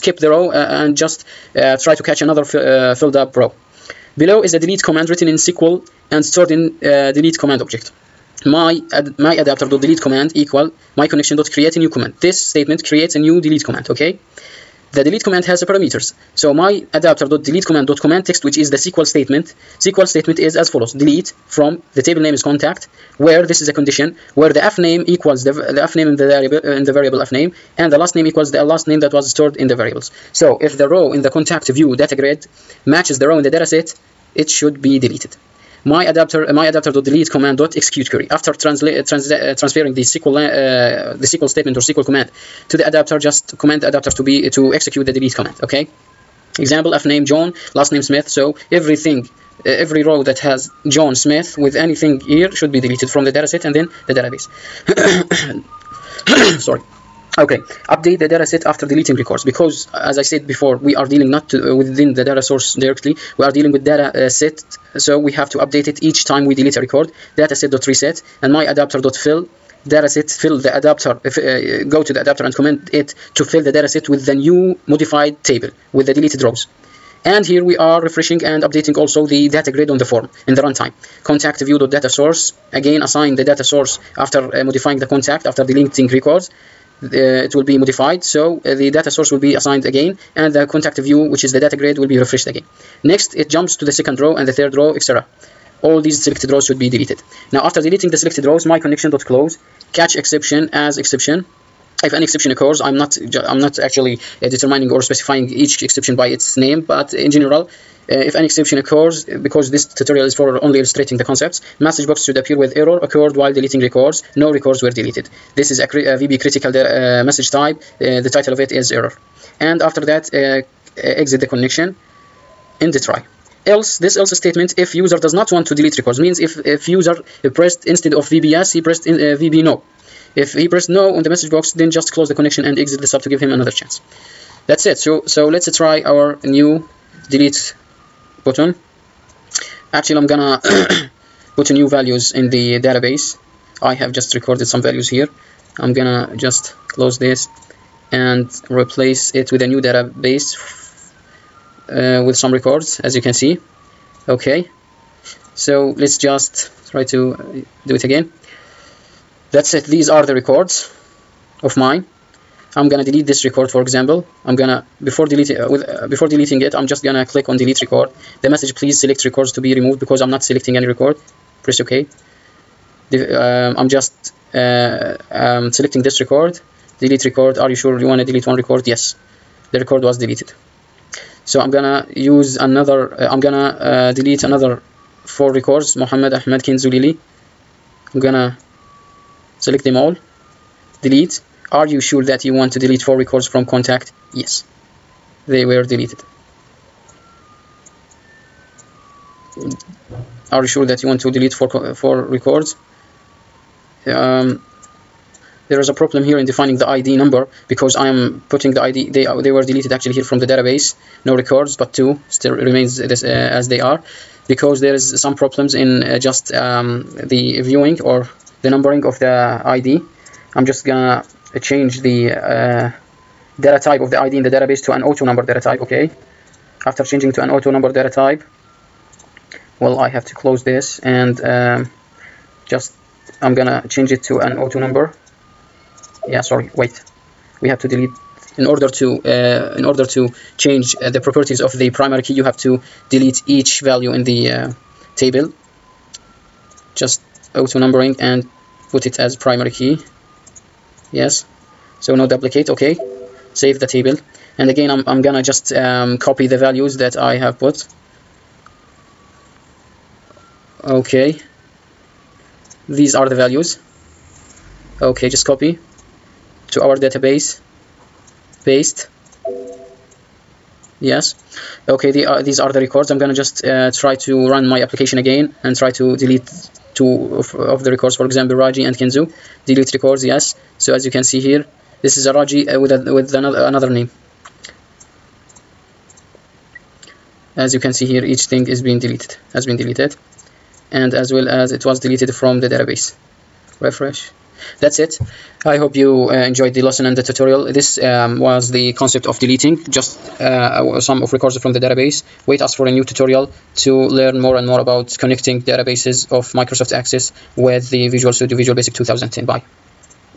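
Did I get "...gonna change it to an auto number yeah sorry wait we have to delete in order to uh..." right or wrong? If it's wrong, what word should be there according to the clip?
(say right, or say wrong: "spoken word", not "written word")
right.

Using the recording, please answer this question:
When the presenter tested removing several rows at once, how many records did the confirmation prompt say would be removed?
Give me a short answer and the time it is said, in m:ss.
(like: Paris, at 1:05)
4, at 3:12.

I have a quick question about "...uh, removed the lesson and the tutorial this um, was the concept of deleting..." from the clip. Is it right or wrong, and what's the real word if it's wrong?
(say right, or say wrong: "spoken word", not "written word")
wrong: "enjoyed", not "removed".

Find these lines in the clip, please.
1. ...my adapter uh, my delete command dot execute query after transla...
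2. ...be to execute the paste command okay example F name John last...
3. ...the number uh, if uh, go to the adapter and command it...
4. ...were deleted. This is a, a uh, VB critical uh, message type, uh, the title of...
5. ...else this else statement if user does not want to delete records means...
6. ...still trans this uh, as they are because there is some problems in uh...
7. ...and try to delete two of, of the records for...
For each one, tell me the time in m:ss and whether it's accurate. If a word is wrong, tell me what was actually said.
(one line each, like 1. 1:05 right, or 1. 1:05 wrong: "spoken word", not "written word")
1. 0:35 right
2. 0:44 wrong: "delete", not "paste"
3. 1:10 wrong: "adapter", not "number"
4. 1:54 right
5. 2:03 right
6. 3:32 wrong: "remains", not "trans"
7. 4:35 right.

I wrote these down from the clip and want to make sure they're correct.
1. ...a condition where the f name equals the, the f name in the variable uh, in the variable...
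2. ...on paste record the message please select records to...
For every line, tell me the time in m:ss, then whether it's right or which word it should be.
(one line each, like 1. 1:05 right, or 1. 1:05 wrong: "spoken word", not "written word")
1. 0:23 right
2. 2:47 wrong: "delete", not "paste".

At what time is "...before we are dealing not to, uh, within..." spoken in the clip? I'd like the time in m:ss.
1:00.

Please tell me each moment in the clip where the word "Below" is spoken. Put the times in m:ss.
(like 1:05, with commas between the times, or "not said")
0:04.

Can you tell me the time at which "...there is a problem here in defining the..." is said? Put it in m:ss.
3:25.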